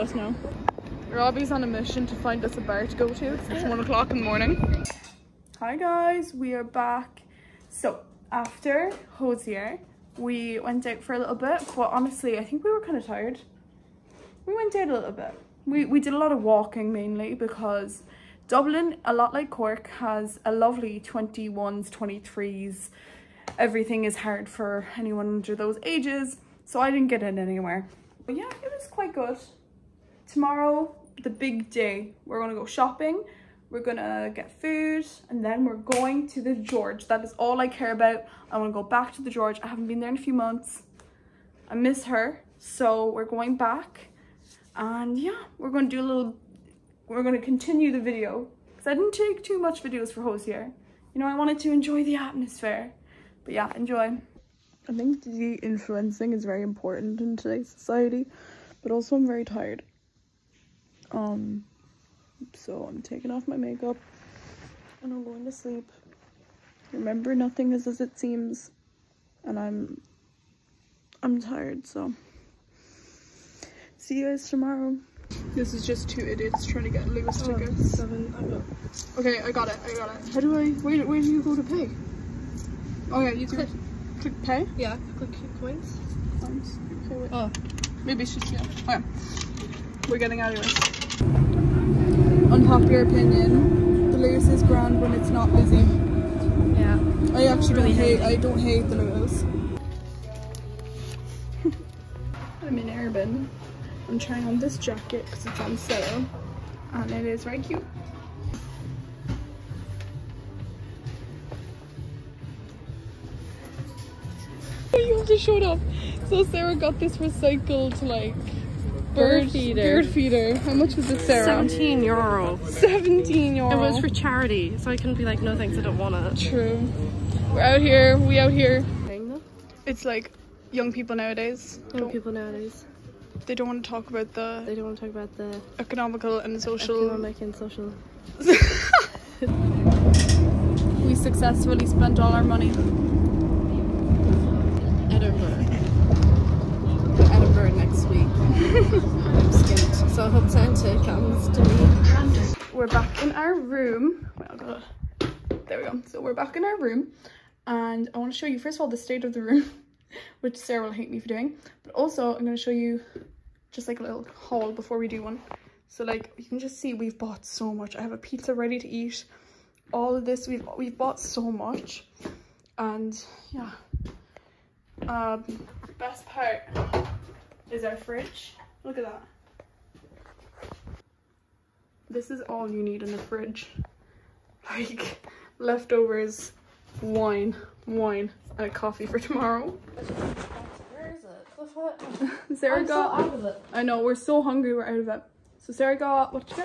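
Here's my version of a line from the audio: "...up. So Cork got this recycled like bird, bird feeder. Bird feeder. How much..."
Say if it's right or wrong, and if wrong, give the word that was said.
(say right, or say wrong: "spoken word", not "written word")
wrong: "Sarah", not "Cork".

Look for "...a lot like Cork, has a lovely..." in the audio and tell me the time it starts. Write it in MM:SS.
00:19.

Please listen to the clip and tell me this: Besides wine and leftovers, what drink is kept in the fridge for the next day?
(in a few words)
Coffee.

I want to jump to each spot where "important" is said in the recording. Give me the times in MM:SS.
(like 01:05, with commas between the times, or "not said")
00:56.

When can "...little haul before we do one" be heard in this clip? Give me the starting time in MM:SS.
02:44.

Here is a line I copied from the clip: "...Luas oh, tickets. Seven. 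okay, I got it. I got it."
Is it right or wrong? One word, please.
right.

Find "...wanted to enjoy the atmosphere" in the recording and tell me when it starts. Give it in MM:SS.
00:51.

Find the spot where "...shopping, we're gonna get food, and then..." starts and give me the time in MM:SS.
00:32.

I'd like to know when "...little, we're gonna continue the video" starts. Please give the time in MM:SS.
00:46.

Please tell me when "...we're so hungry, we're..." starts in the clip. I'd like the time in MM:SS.
03:14.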